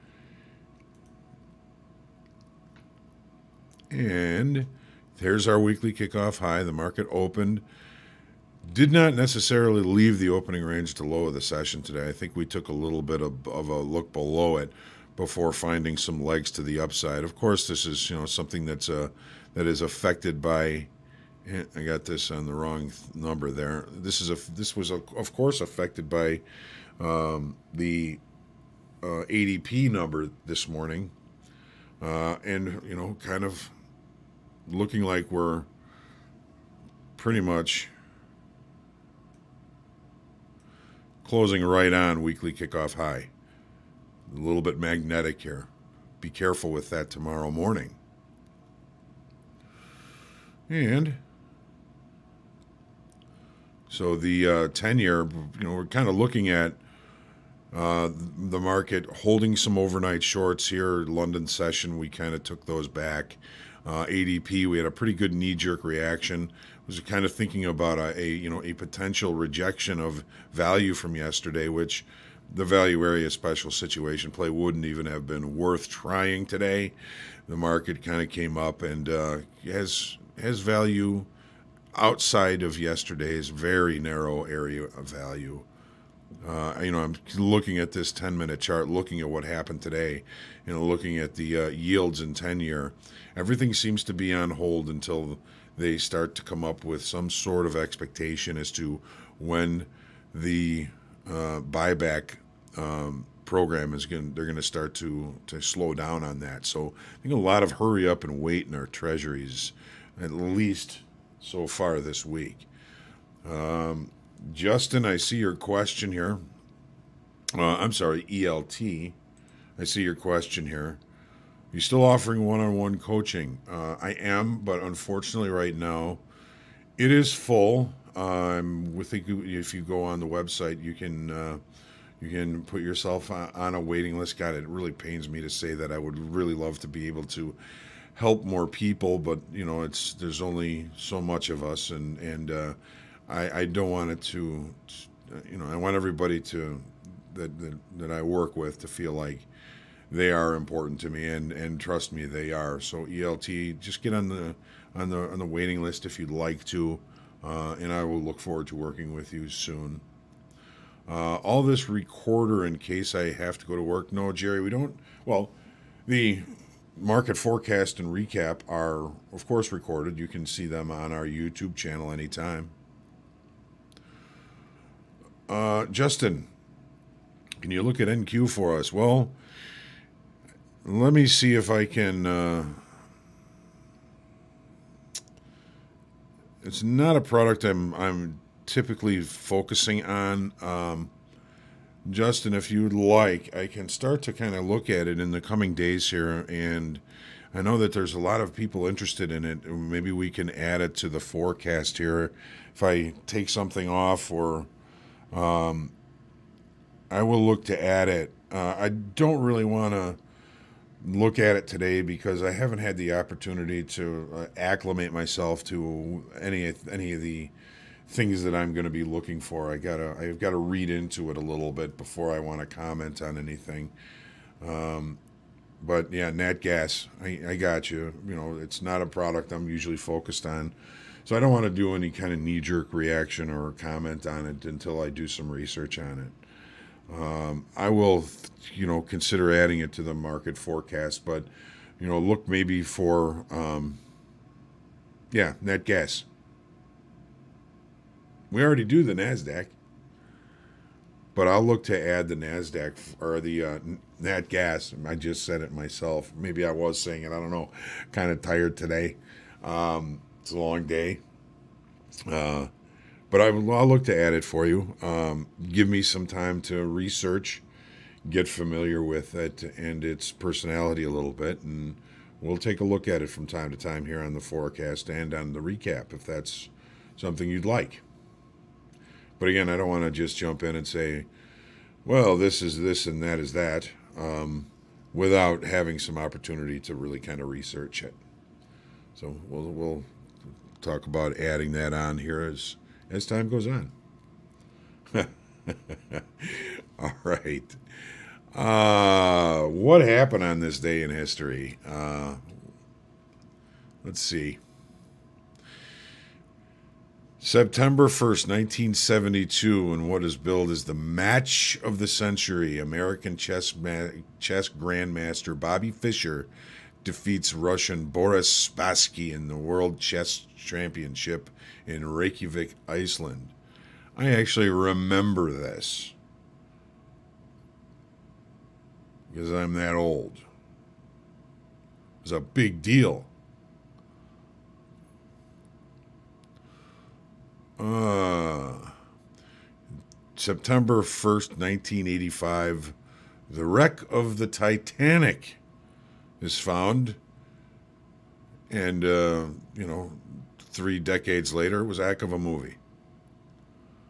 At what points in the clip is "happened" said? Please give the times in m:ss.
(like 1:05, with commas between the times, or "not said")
1:29, 5:00.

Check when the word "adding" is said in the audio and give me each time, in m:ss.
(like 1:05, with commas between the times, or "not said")
3:59, 4:51.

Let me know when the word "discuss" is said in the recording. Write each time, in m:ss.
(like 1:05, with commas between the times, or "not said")
not said.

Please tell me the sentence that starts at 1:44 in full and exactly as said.
They're going to start to to slow down on that.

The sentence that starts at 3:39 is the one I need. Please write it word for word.
I gotta I've got to read into it a little bit before I want to comment on anything.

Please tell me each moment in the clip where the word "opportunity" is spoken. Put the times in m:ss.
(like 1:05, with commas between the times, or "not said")
3:33, 4:46.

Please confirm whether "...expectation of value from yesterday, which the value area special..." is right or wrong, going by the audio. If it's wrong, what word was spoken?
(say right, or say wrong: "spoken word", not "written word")
wrong: "rejection", not "expectation".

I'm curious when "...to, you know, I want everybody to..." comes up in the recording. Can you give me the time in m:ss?
2:24.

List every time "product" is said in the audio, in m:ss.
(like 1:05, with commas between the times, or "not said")
3:07, 3:49.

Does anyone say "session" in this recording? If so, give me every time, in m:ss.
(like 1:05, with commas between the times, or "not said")
0:11, 1:01.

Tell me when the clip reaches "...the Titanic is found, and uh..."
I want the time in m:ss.
5:44.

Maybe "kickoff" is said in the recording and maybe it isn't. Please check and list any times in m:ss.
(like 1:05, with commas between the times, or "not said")
0:05, 0:42.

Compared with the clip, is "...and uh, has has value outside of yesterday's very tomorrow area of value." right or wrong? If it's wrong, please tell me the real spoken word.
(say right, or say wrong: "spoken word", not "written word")
wrong: "narrow", not "tomorrow".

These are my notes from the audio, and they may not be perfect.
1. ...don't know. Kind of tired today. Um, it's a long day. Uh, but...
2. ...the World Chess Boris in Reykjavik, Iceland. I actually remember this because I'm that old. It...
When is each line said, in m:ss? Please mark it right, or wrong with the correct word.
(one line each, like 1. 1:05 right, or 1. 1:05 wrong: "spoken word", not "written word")
1. 4:17 right
2. 5:19 wrong: "Championship", not "Boris".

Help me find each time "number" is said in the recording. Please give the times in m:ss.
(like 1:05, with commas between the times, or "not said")
0:23, 0:29.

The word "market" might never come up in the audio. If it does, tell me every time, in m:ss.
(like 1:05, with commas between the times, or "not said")
0:06, 0:58, 1:17, 2:46, 4:00.